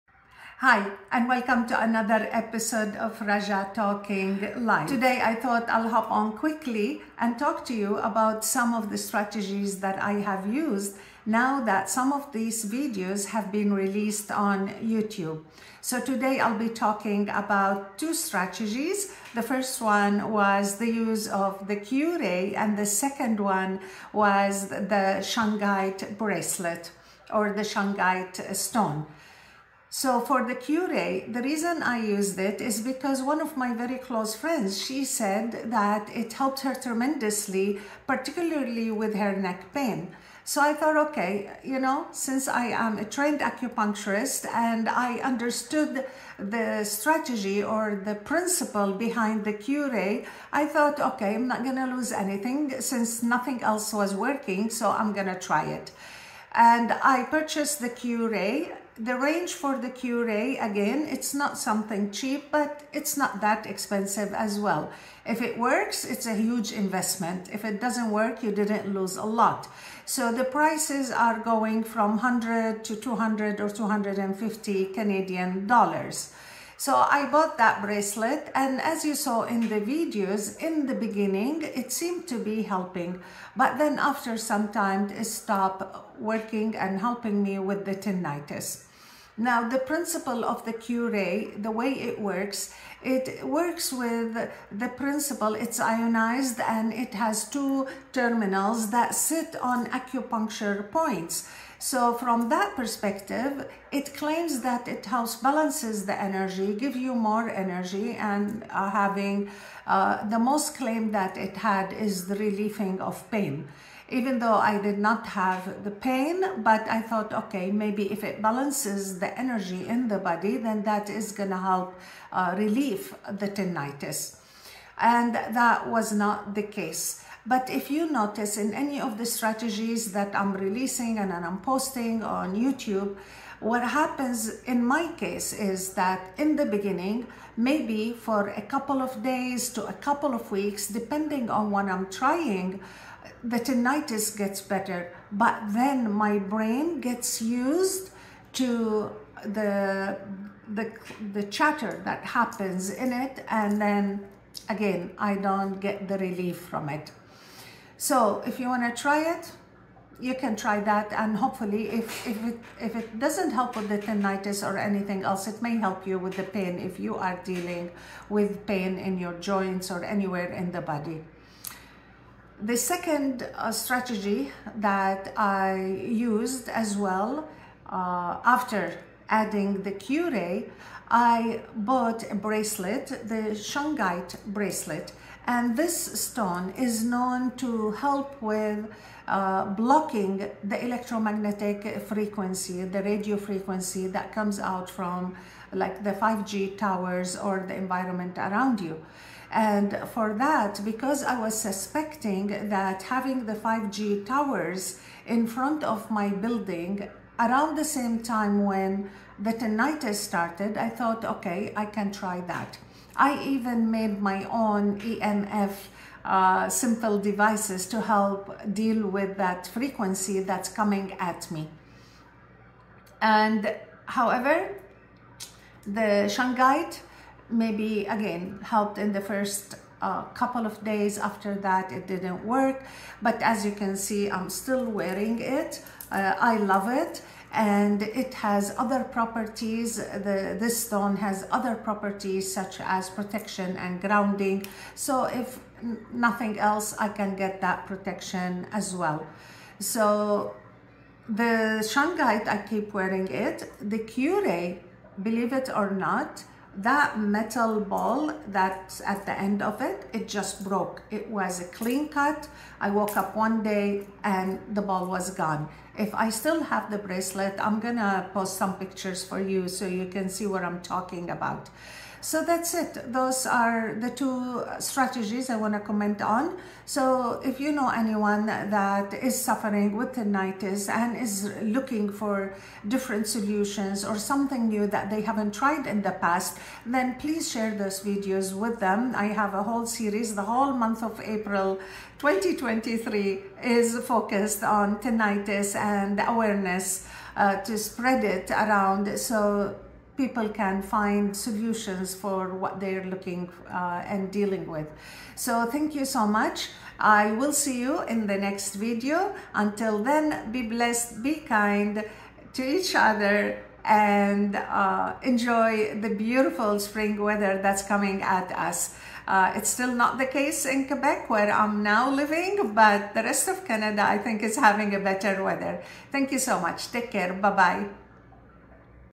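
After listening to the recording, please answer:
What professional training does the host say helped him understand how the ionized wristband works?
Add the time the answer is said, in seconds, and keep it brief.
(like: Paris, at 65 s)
Acupuncturist, at 43 s.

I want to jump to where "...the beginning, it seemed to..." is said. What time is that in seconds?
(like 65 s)
80 s.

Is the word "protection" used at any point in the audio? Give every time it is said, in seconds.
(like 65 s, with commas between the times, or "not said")
243 s, 247 s.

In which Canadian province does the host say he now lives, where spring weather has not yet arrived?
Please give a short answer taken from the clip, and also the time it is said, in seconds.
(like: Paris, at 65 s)
Quebec, at 320 s.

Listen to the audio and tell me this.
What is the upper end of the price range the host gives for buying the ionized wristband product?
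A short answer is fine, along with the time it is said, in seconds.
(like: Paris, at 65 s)
250 Canadian dollars, at 73 s.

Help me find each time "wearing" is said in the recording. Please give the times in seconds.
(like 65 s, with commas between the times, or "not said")
234 s, 252 s.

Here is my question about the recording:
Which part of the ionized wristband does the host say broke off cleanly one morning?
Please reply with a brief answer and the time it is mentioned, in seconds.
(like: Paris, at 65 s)
Metal ball, at 257 s.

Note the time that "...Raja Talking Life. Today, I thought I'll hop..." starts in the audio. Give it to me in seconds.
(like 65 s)
3 s.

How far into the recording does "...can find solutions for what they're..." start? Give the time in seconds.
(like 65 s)
300 s.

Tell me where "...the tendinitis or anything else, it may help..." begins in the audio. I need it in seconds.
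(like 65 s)
163 s.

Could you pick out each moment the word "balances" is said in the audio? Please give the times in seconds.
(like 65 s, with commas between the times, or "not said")
105 s, 118 s.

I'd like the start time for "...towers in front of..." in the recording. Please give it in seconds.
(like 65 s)
204 s.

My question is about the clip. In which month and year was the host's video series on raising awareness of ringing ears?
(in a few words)
April 2023.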